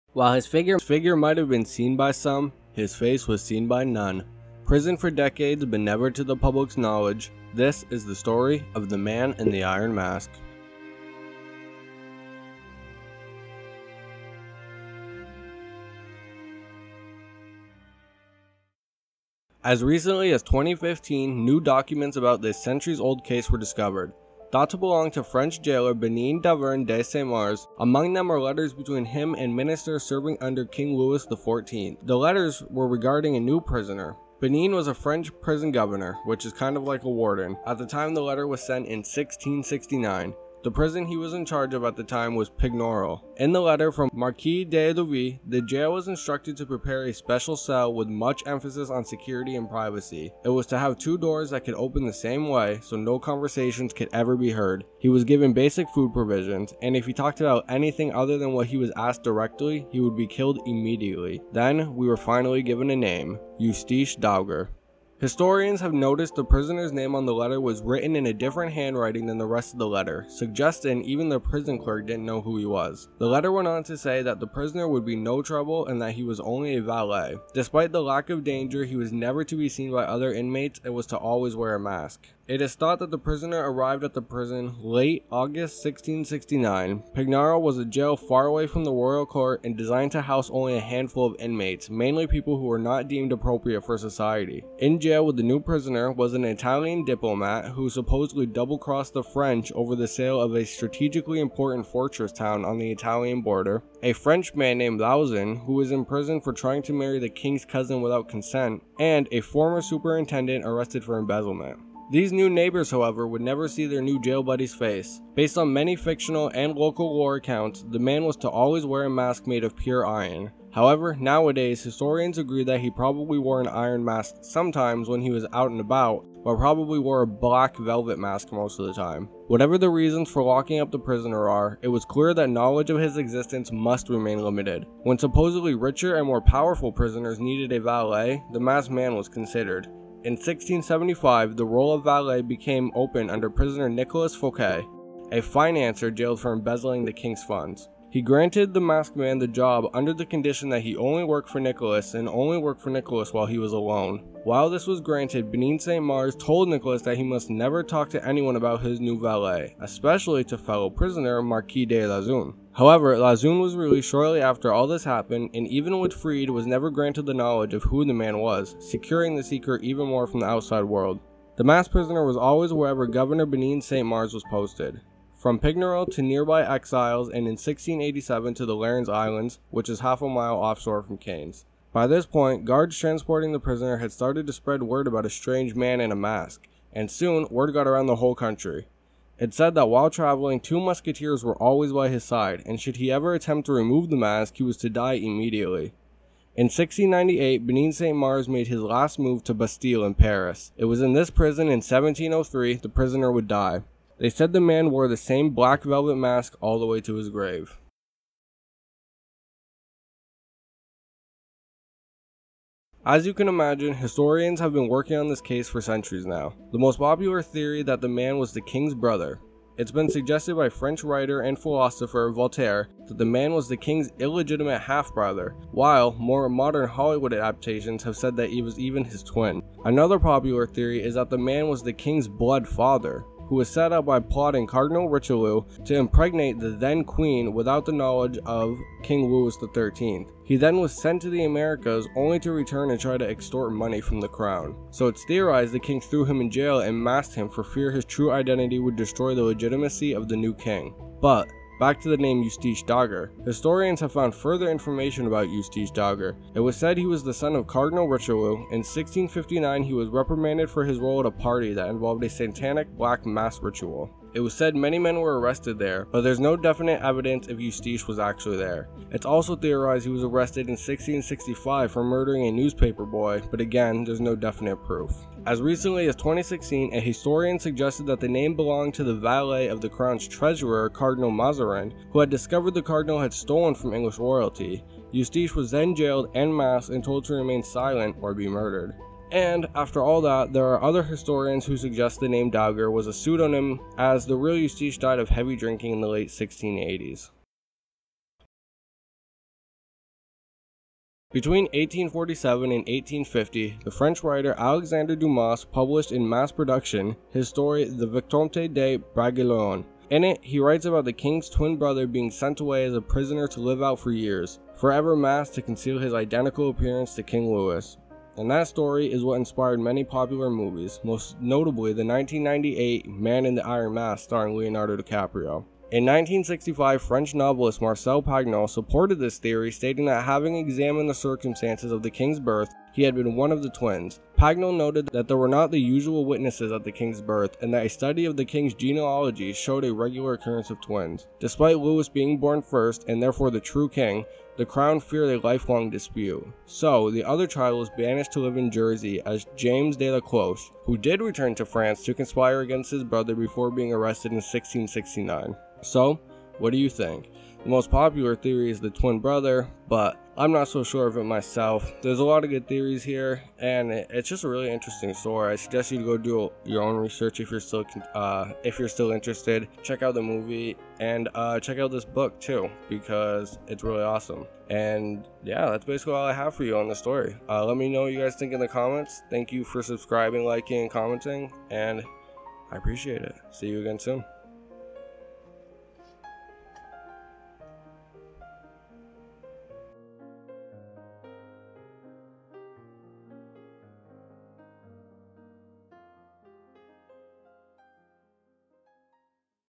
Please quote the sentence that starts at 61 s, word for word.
Then, we were finally given a name, Eustache Dauger.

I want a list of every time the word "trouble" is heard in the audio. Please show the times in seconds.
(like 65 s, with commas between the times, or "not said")
75 s.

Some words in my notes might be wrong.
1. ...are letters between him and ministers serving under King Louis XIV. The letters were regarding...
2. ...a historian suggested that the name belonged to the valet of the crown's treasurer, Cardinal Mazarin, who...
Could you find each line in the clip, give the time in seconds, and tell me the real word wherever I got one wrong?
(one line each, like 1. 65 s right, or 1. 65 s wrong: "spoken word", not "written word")
1. 28 s right
2. 276 s right.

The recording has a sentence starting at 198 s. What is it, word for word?
Mars made his last move to Bastille in Paris.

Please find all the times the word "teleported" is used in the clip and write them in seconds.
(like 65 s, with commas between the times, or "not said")
not said.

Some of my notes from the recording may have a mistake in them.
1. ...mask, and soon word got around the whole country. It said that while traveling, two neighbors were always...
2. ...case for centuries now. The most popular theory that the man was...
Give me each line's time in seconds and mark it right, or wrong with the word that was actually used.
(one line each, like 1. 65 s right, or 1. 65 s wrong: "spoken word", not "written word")
1. 186 s wrong: "musketeers", not "neighbors"
2. 215 s right.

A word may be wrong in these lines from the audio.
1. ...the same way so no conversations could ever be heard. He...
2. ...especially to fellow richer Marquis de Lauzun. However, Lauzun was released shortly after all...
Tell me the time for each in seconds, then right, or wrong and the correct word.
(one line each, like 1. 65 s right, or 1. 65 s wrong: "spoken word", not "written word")
1. 52 s right
2. 159 s wrong: "prisoner", not "richer".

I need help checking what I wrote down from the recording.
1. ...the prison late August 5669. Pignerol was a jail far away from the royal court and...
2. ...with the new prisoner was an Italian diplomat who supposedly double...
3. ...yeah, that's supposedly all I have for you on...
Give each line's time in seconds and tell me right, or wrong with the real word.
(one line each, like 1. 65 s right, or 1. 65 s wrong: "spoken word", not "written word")
1. 84 s wrong: "1669", not "5669"
2. 95 s right
3. 375 s wrong: "basically", not "supposedly".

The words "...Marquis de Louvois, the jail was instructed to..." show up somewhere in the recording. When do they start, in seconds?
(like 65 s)
44 s.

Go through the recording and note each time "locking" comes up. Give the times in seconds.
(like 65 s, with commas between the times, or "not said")
130 s.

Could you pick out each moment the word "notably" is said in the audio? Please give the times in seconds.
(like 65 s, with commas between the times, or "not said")
321 s.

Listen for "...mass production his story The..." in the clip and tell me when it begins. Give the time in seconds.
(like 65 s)
306 s.